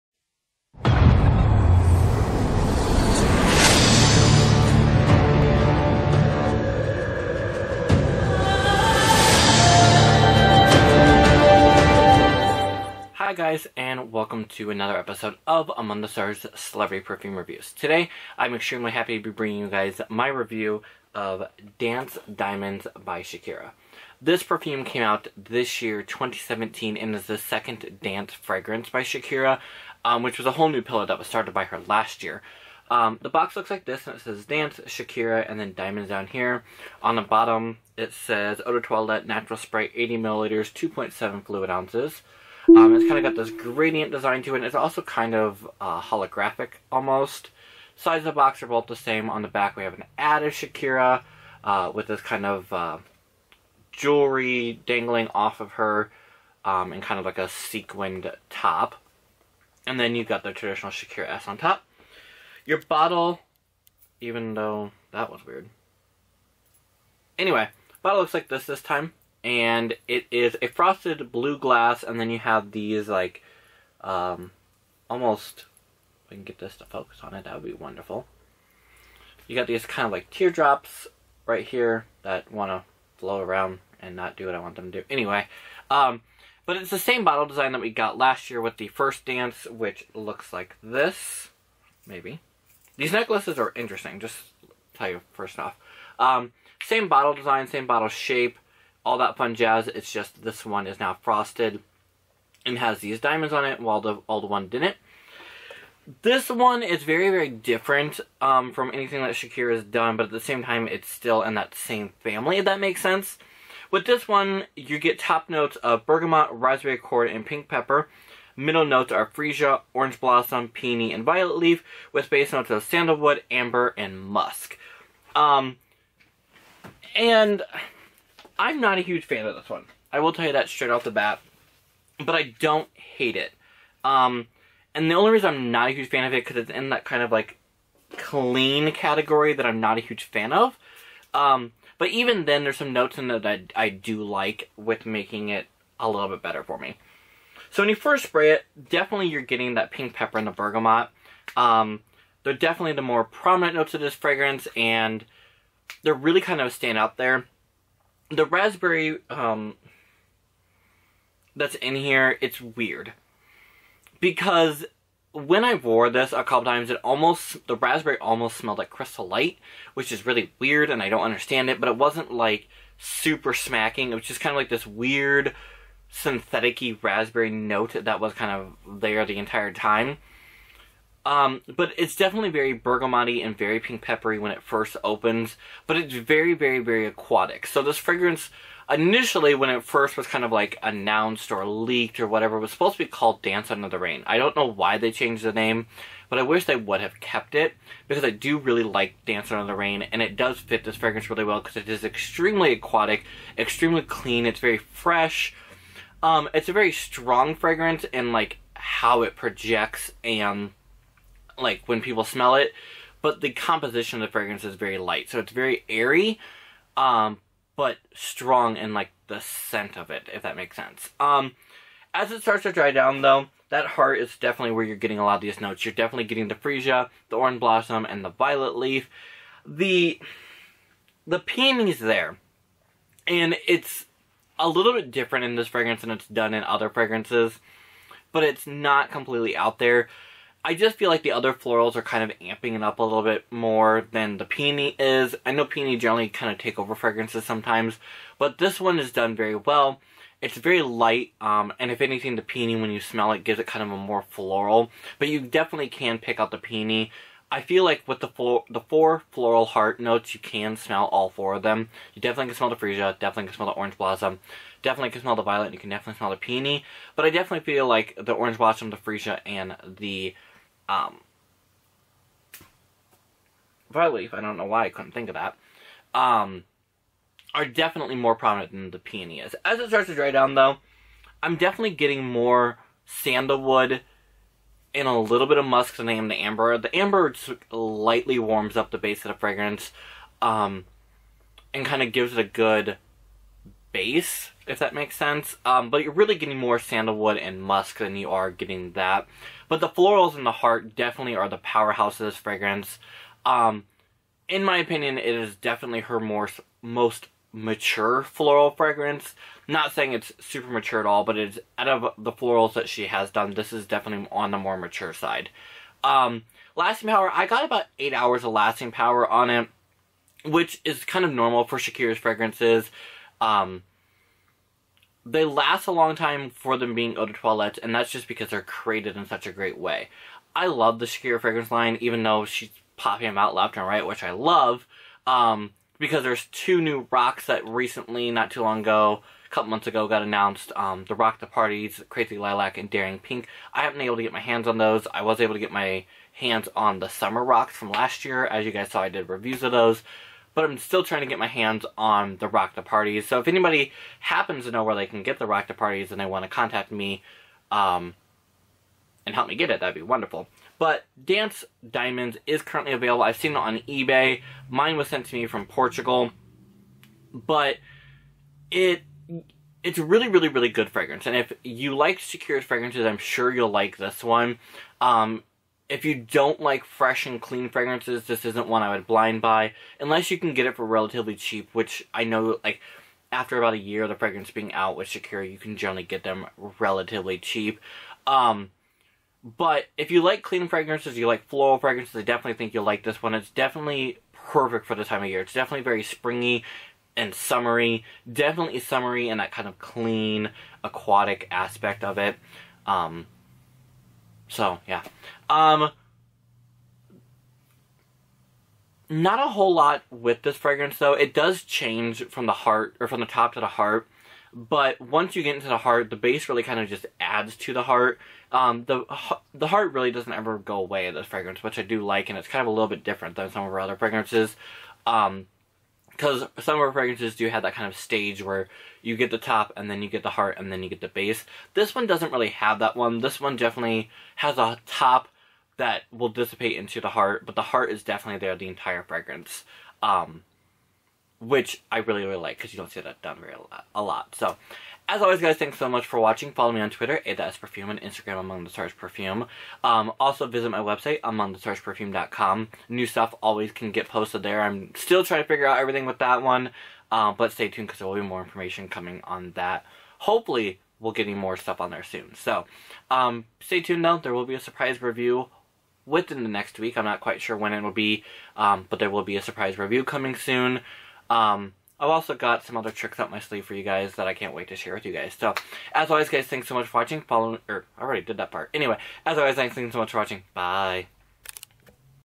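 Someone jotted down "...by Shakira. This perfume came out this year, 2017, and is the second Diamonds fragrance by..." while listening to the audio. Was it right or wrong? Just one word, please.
wrong.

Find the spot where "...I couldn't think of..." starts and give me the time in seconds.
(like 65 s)
274 s.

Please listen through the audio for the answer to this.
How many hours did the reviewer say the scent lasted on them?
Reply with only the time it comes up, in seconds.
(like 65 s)
317 s.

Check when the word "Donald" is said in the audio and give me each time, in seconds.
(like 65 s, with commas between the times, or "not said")
not said.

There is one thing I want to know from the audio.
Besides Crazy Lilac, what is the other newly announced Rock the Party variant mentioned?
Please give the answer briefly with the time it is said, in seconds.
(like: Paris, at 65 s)
Daring Pink, at 342 s.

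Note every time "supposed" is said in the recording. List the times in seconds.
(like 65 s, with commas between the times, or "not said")
192 s.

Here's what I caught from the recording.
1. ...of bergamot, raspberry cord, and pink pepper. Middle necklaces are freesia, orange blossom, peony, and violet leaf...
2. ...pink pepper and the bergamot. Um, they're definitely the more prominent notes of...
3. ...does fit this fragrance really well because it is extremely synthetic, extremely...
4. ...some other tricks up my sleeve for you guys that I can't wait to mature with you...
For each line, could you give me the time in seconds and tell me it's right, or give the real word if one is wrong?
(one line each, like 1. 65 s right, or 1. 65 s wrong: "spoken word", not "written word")
1. 115 s wrong: "notes", not "necklaces"
2. 149 s right
3. 200 s wrong: "aquatic", not "synthetic"
4. 472 s wrong: "share", not "mature".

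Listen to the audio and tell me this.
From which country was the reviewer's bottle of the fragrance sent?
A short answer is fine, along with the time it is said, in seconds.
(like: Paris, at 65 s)
Portugal, at 365 s.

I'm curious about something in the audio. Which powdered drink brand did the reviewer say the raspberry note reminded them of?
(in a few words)
Crystal Light.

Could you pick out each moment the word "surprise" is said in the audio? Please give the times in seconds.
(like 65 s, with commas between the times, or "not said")
464 s, 469 s.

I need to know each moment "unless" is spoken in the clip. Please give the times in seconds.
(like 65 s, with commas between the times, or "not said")
379 s.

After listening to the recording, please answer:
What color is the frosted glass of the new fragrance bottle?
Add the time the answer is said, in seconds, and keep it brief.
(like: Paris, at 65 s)
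blue, at 70 s.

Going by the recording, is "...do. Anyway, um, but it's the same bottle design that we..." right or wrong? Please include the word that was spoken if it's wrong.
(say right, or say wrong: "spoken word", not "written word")
right.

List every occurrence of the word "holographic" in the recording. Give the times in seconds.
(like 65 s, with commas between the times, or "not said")
45 s.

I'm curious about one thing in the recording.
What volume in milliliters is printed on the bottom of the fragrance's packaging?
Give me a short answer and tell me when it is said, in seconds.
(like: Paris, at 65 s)
80 milliliters, at 39 s.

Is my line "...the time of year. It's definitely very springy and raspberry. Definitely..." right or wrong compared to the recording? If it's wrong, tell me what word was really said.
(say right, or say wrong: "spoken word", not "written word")
wrong: "summery", not "raspberry".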